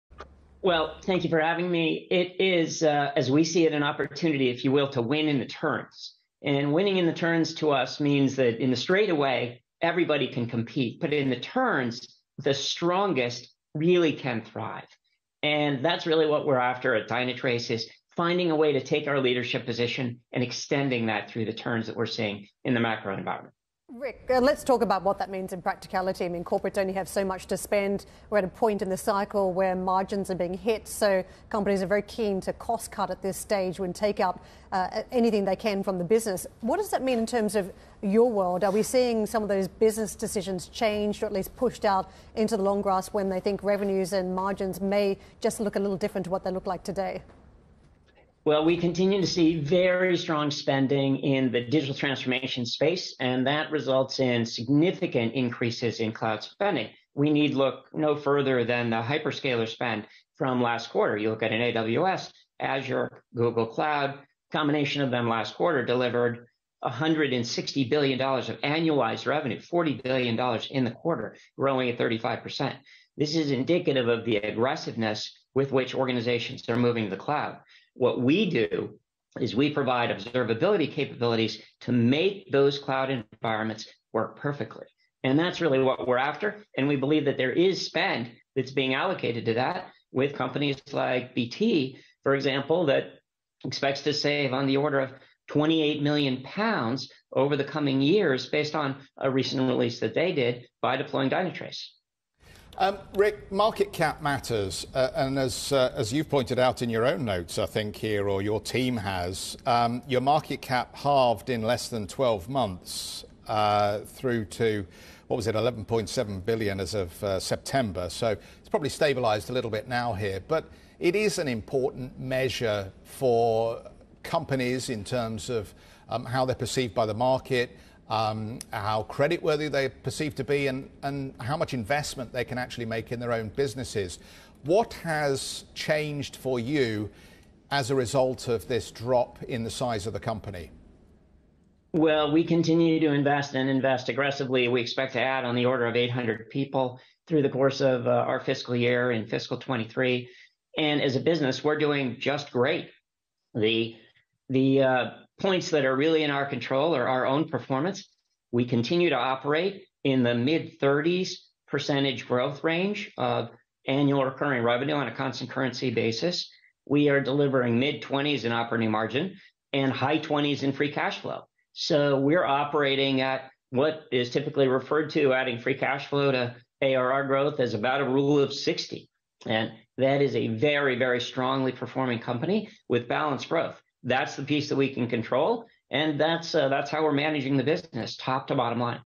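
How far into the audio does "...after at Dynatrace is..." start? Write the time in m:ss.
0:16.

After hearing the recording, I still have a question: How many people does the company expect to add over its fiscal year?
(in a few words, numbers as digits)
800.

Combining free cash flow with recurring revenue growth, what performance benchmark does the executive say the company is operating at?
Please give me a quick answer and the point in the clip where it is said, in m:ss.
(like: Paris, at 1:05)
Rule of 60, at 2:58.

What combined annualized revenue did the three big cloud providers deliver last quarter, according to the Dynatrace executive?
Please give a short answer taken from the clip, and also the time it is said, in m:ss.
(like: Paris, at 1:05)
$160 billion, at 1:06.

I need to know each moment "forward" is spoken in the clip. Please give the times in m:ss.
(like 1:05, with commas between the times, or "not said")
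not said.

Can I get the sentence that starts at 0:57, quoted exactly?
We need look no further than the hyperscaler spend from last quarter.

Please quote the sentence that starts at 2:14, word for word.
What has changed for you as a result of this drop in the size of the company?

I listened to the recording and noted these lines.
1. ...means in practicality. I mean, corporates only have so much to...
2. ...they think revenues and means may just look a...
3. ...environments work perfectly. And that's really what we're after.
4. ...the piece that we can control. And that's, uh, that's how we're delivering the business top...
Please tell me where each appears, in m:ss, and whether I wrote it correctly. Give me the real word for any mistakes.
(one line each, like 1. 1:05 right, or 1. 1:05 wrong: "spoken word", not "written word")
1. 0:25 right
2. 0:43 wrong: "margins", not "means"
3. 1:23 right
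4. 3:04 wrong: "managing", not "delivering".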